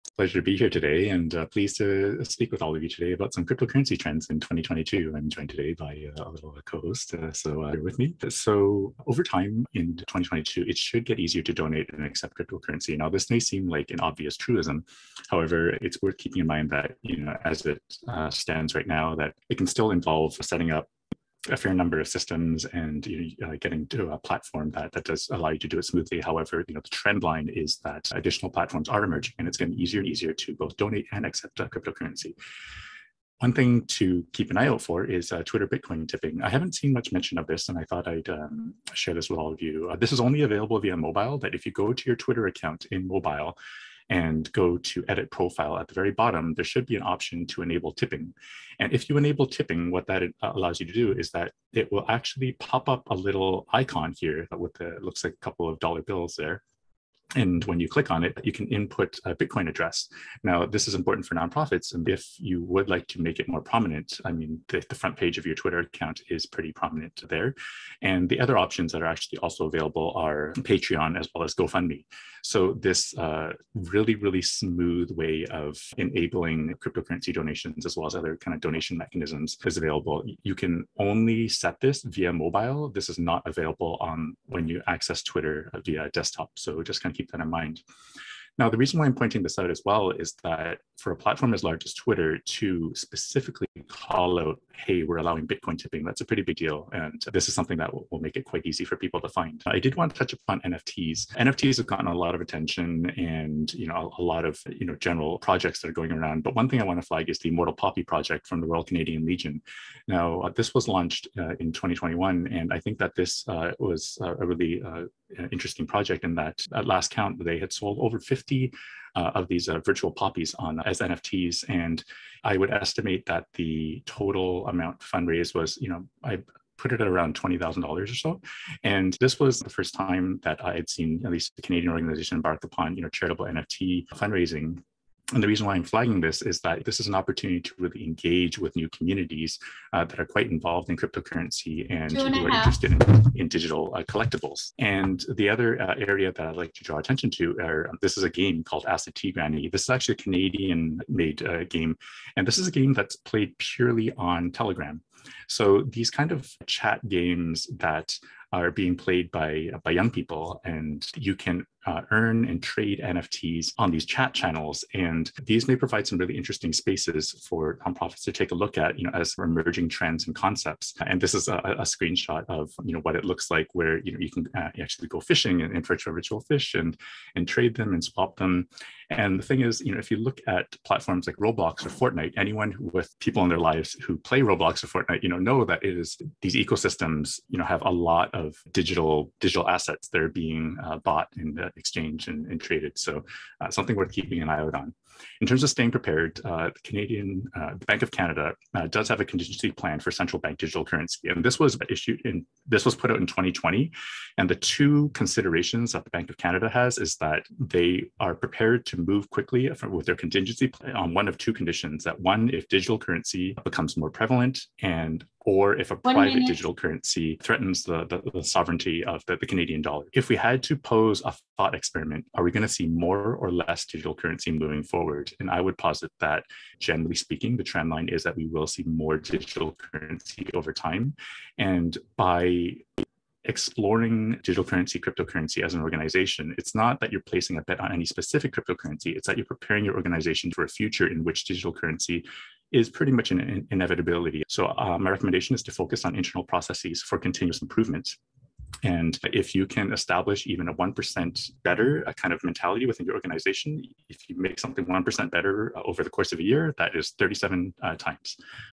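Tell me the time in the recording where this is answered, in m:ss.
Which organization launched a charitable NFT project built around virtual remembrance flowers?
1:48.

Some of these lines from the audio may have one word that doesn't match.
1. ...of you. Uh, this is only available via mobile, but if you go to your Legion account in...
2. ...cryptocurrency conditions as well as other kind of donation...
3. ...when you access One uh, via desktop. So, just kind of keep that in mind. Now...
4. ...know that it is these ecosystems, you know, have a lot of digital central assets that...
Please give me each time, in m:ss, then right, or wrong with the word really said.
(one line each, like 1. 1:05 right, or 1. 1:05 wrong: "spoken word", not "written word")
1. 0:39 wrong: "Twitter", not "Legion"
2. 1:16 wrong: "donations", not "conditions"
3. 1:24 wrong: "Twitter", not "One"
4. 3:05 wrong: "digital", not "central".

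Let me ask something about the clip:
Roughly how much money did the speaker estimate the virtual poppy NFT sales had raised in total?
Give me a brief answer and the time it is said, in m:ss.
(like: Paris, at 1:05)
$20,000, at 2:07.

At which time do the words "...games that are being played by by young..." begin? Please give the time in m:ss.
2:37.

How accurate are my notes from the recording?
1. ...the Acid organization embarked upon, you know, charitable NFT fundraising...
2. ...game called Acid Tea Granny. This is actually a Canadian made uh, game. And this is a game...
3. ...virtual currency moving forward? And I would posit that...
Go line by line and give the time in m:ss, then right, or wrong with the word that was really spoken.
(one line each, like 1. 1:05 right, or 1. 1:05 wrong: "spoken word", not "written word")
1. 2:11 wrong: "Canadian", not "Acid"
2. 2:28 right
3. 3:43 wrong: "digital", not "virtual".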